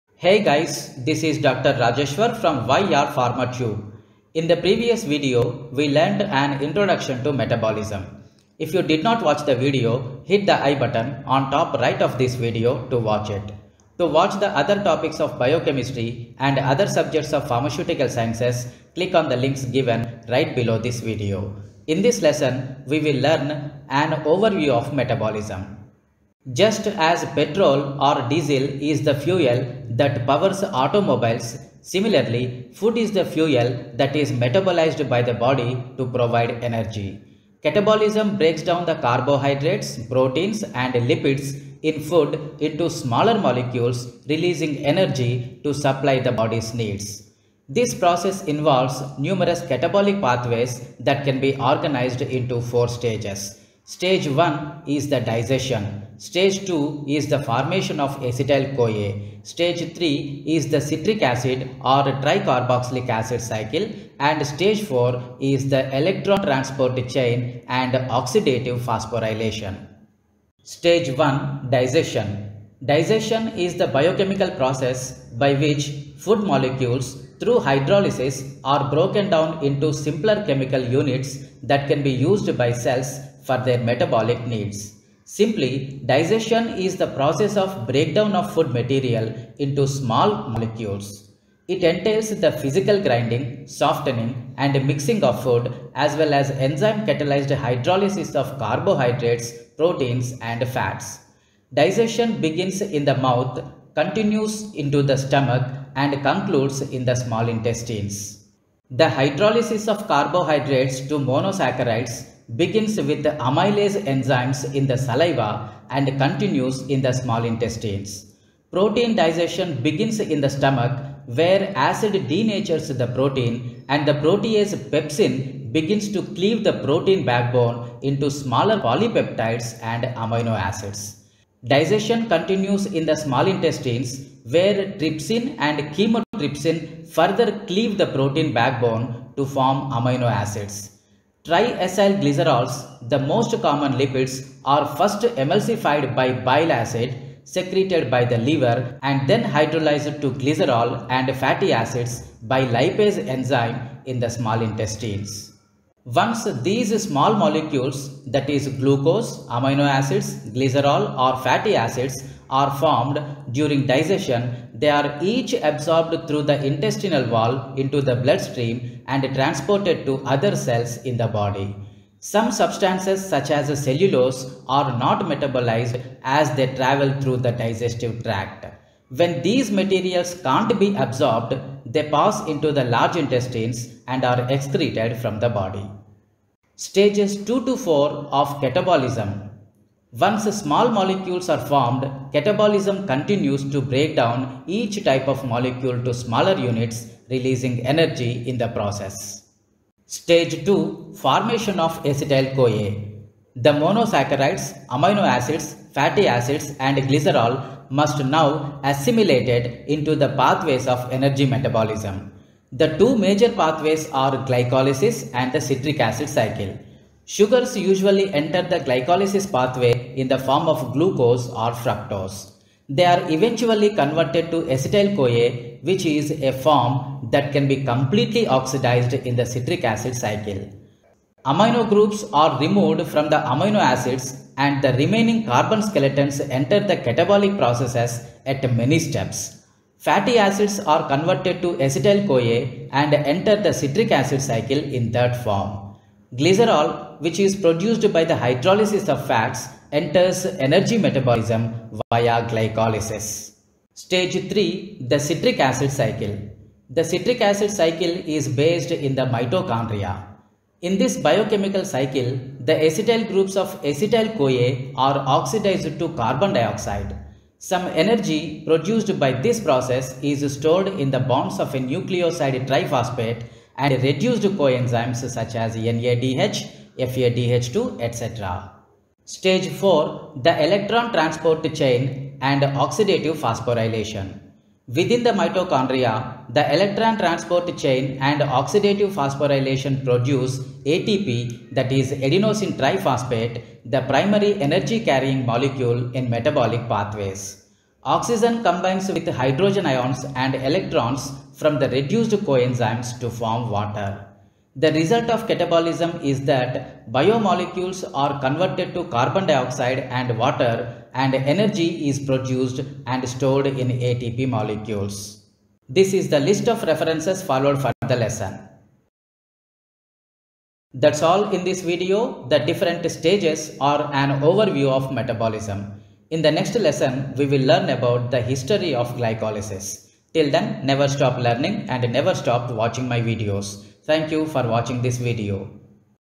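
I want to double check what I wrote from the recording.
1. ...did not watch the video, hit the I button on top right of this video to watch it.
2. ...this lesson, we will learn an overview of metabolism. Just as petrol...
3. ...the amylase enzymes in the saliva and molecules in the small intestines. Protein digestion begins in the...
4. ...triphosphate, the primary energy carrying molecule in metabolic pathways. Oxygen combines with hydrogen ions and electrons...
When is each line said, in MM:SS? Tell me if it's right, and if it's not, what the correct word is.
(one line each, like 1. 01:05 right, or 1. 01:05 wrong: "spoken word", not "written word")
1. 00:08 right
2. 00:22 right
3. 01:53 wrong: "continues", not "molecules"
4. 04:52 right.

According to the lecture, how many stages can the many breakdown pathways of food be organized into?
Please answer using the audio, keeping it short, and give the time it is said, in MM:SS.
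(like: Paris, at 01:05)
4, at 00:52.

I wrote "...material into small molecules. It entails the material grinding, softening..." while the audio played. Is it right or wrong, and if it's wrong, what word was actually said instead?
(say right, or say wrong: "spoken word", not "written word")
wrong: "physical", not "material".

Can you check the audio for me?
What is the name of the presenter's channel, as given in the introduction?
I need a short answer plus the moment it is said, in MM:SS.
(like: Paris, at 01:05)
YR Pharma Tube, at 00:02.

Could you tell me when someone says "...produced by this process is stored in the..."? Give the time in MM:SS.
04:28.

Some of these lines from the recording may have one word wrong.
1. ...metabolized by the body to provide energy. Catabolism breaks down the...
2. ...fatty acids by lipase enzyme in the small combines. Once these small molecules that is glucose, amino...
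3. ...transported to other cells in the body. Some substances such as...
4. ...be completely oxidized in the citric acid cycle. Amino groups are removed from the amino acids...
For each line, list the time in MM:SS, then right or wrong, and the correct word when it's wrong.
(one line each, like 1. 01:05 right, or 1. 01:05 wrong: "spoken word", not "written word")
1. 00:34 right
2. 02:31 wrong: "intestines", not "combines"
3. 02:49 right
4. 03:47 right.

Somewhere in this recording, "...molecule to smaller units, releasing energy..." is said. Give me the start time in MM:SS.
03:15.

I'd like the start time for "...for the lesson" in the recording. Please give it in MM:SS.
05:17.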